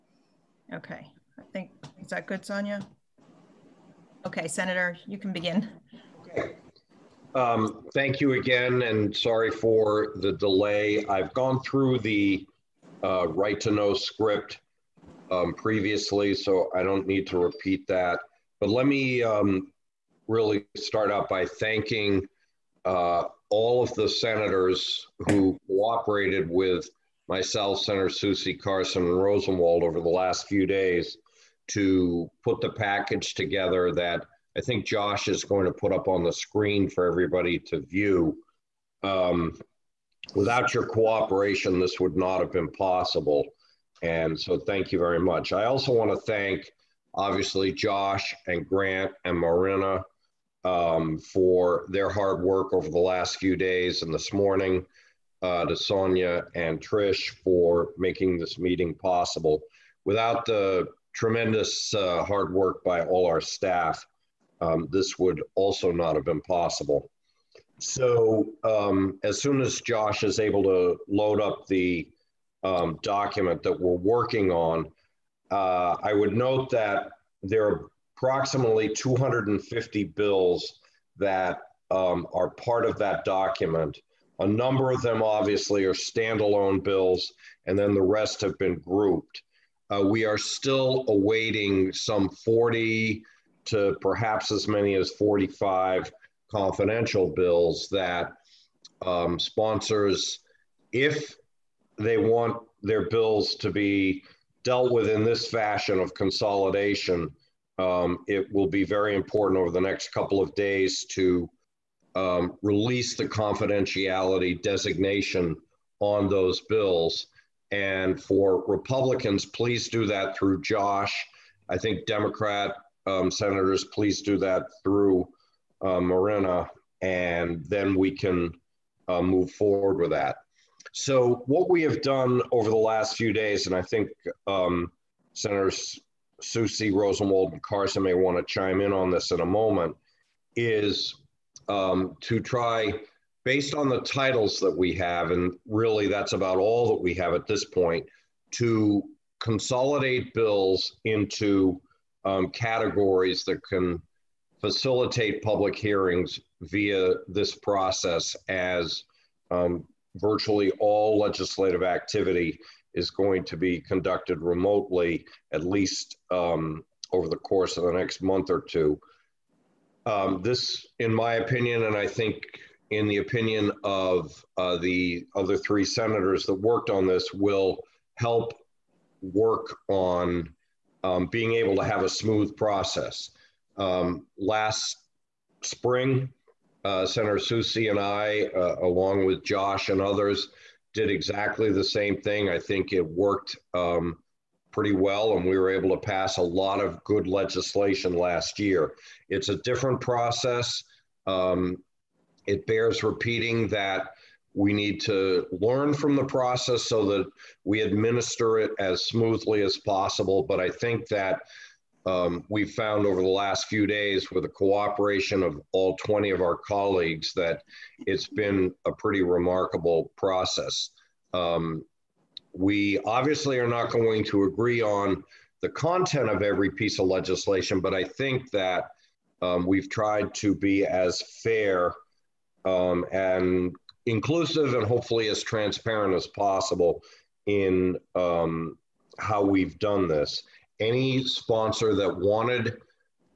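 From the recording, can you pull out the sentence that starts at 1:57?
And for Republicans, please do that through Josh.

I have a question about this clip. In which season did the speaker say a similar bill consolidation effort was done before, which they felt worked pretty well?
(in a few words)
Spring.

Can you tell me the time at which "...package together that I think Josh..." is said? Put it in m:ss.
0:32.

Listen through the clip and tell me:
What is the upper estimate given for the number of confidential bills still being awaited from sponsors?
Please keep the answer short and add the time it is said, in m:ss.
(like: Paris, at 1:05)
45, at 1:34.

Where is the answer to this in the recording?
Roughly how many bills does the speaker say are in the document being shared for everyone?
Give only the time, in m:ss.
1:18.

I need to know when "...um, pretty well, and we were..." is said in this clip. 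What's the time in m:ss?
3:13.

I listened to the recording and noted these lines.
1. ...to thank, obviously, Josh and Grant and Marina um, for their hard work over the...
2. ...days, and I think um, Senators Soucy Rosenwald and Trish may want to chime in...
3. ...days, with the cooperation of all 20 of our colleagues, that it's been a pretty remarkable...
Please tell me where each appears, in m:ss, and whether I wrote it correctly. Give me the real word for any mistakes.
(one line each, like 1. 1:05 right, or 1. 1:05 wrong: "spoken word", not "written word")
1. 0:46 right
2. 2:13 wrong: "Carson", not "Trish"
3. 3:33 right.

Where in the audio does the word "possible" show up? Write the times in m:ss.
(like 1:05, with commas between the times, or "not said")
0:42, 0:58, 1:06, 3:29, 3:56.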